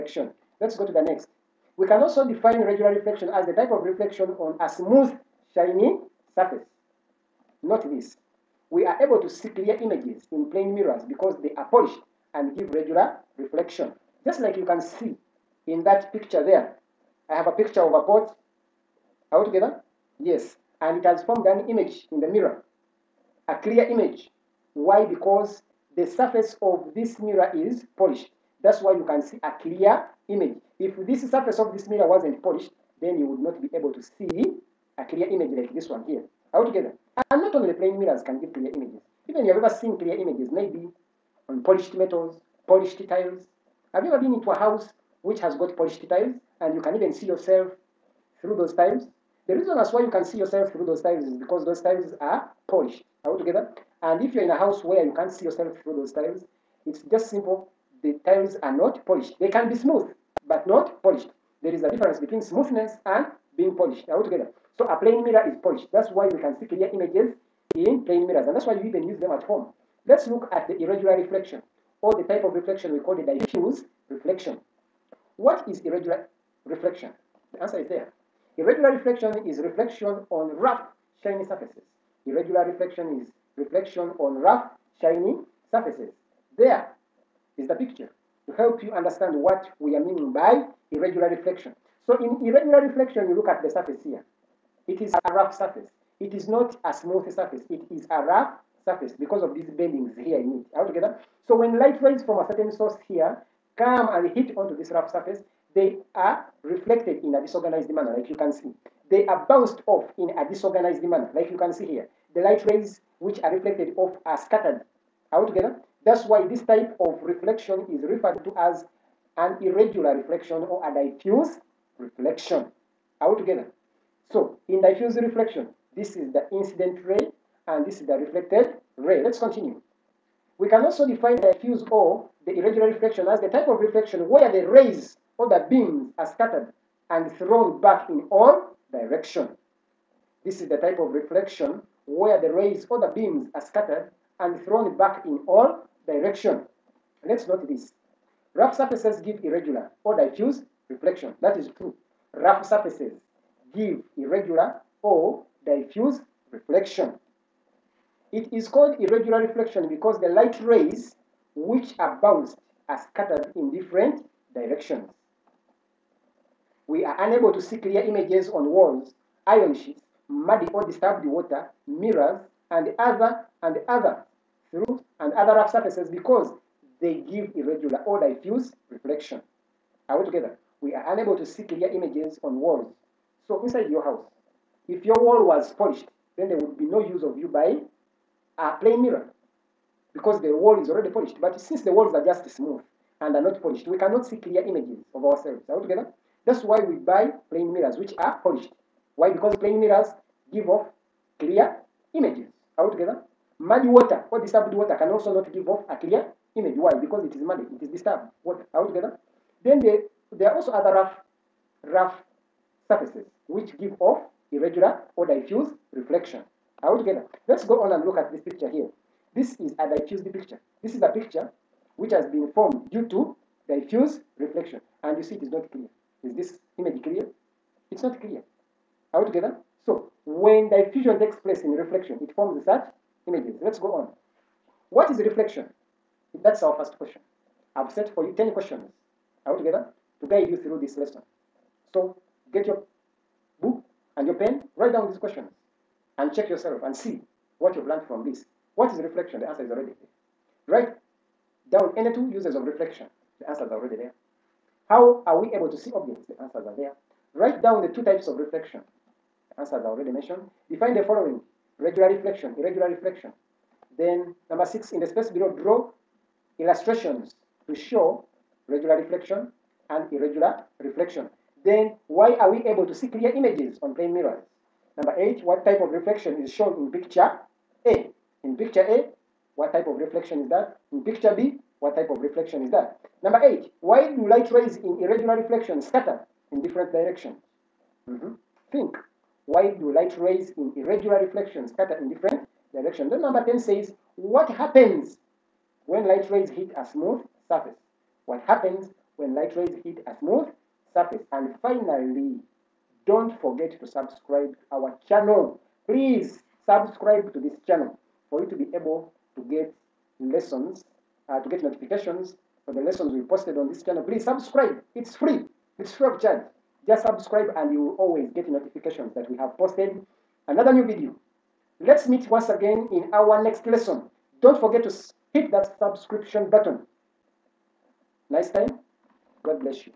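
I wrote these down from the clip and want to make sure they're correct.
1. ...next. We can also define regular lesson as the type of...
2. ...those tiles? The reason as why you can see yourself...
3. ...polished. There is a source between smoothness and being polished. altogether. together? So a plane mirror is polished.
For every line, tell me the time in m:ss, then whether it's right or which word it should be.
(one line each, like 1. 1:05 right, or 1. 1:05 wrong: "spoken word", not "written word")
1. 0:01 wrong: "reflection", not "lesson"
2. 0:48 right
3. 1:01 wrong: "difference", not "source".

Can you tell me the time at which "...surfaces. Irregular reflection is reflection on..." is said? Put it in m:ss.
1:21.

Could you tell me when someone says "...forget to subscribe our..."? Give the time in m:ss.
5:03.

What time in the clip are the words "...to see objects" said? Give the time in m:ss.
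4:15.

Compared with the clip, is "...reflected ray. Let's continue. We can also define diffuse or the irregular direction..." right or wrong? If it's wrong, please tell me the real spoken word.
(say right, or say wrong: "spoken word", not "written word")
wrong: "reflection", not "direction".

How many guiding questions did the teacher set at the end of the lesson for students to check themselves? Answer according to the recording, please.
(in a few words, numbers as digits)
10.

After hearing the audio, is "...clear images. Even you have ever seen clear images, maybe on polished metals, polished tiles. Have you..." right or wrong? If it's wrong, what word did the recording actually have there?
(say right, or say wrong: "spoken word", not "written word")
right.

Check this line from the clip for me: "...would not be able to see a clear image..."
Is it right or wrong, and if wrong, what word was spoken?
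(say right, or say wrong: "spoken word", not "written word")
right.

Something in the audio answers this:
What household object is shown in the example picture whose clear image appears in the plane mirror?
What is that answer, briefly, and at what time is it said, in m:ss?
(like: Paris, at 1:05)
A pot, at 0:17.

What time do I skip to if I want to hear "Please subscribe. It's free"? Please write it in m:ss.
5:14.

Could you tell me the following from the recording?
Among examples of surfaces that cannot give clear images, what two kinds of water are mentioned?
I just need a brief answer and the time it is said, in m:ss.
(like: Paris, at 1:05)
Muddy or disturbed water, at 2:50.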